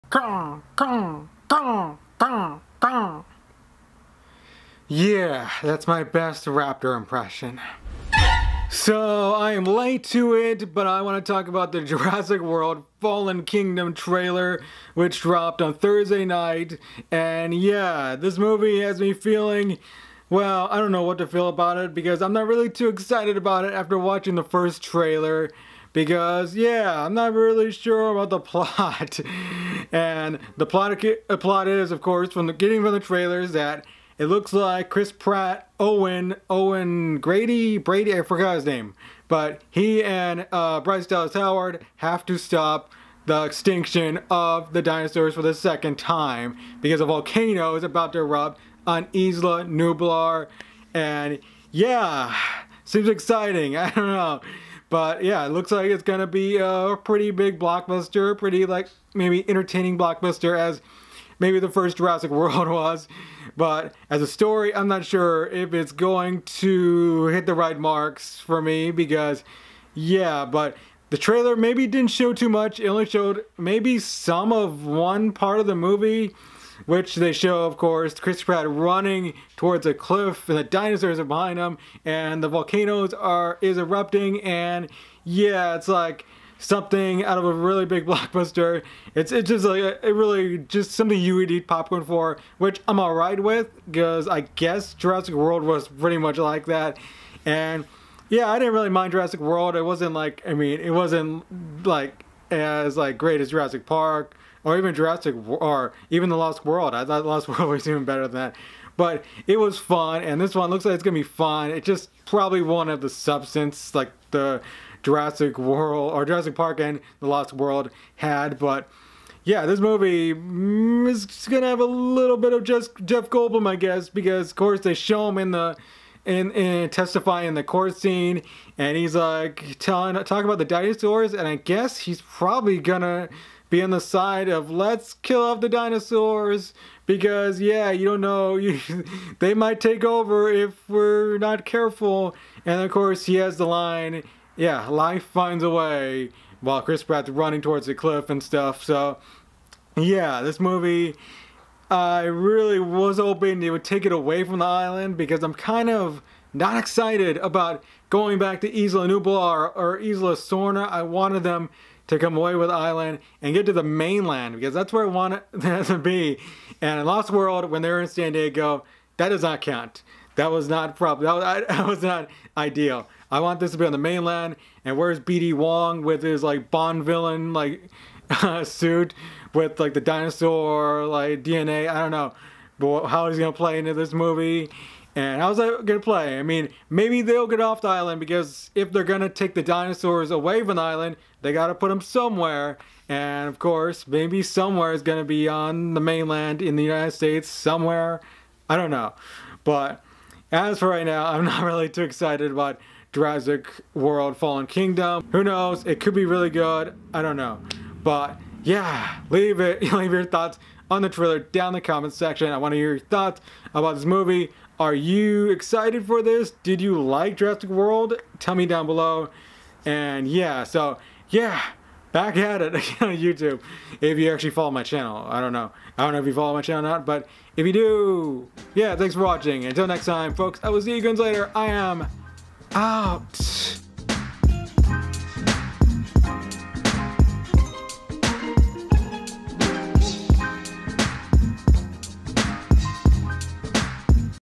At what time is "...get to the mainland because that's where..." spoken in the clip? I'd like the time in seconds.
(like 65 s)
163 s.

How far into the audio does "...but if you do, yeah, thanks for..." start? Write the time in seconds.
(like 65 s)
227 s.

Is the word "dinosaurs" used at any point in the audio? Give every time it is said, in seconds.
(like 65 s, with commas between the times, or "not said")
44 s, 80 s, 130 s, 135 s, 180 s, 189 s.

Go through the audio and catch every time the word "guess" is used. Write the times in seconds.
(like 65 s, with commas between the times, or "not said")
94 s, 123 s, 131 s.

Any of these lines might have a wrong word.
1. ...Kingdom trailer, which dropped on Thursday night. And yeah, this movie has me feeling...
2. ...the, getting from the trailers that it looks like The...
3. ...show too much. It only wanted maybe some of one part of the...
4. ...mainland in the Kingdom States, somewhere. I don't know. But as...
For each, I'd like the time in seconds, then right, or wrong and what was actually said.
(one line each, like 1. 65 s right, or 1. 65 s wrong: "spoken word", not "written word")
1. 13 s right
2. 32 s wrong: "Chris", not "The"
3. 72 s wrong: "showed", not "wanted"
4. 196 s wrong: "United", not "Kingdom".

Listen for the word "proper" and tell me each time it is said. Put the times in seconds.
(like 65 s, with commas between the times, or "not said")
170 s.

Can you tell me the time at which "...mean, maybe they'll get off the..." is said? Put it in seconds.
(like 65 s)
186 s.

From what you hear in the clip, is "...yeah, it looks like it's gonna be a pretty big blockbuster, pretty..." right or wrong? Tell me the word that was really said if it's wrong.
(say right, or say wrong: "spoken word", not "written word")
right.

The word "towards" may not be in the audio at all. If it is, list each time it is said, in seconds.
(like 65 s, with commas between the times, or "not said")
79 s, 147 s.